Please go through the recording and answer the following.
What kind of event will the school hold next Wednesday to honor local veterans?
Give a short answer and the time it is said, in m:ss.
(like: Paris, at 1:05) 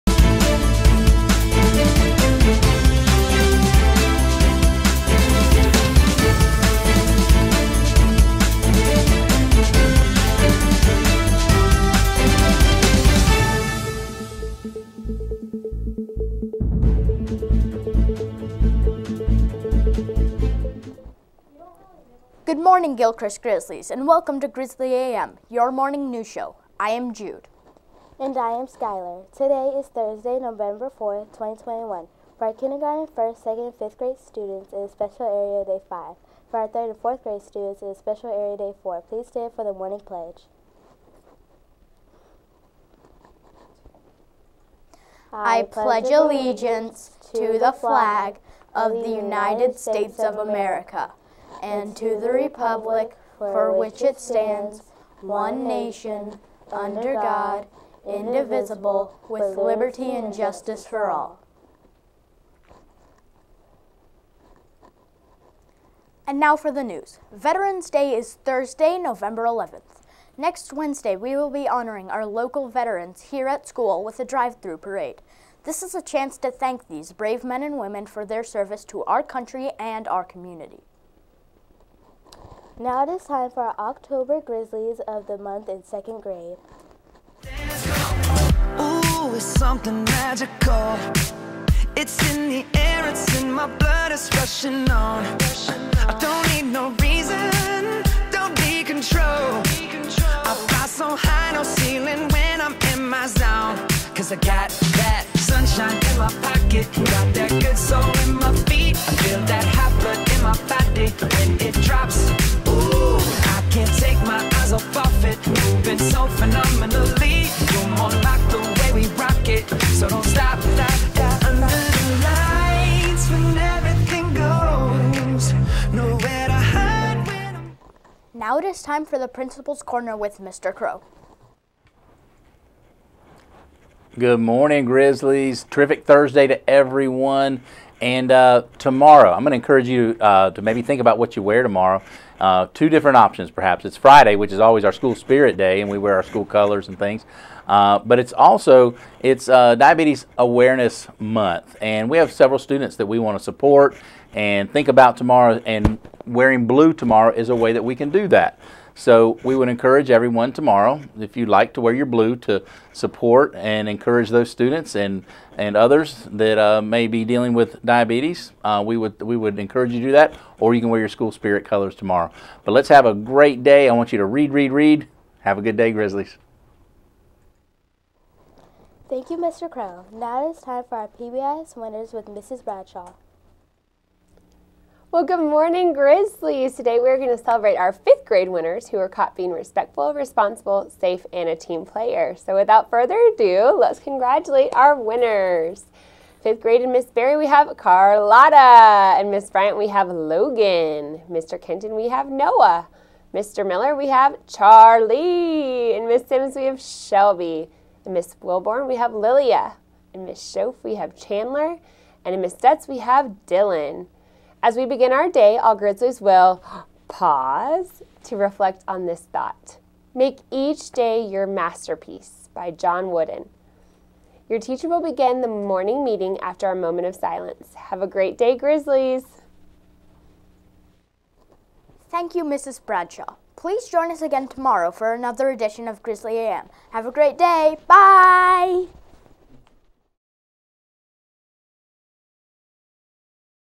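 Drive-through parade, at 1:14.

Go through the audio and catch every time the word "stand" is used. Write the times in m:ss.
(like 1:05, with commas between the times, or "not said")
0:39, 0:54.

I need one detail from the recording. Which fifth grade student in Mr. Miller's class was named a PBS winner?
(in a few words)
Charlie.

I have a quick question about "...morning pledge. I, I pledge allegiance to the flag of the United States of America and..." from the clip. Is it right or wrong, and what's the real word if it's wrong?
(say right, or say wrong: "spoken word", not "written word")
right.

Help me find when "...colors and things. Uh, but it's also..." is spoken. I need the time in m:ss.
2:26.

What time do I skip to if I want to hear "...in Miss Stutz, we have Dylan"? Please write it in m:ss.
3:32.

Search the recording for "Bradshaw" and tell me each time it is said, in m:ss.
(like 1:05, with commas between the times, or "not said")
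3:02, 3:52.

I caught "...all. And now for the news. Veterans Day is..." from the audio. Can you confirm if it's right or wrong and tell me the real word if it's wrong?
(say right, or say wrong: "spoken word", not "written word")
right.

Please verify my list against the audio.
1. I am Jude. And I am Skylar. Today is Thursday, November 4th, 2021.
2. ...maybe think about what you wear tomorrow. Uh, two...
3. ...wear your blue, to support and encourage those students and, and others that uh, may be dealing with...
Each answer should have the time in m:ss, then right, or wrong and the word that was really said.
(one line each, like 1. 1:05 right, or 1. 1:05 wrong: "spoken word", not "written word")
1. 0:26 right
2. 2:20 right
3. 2:41 right.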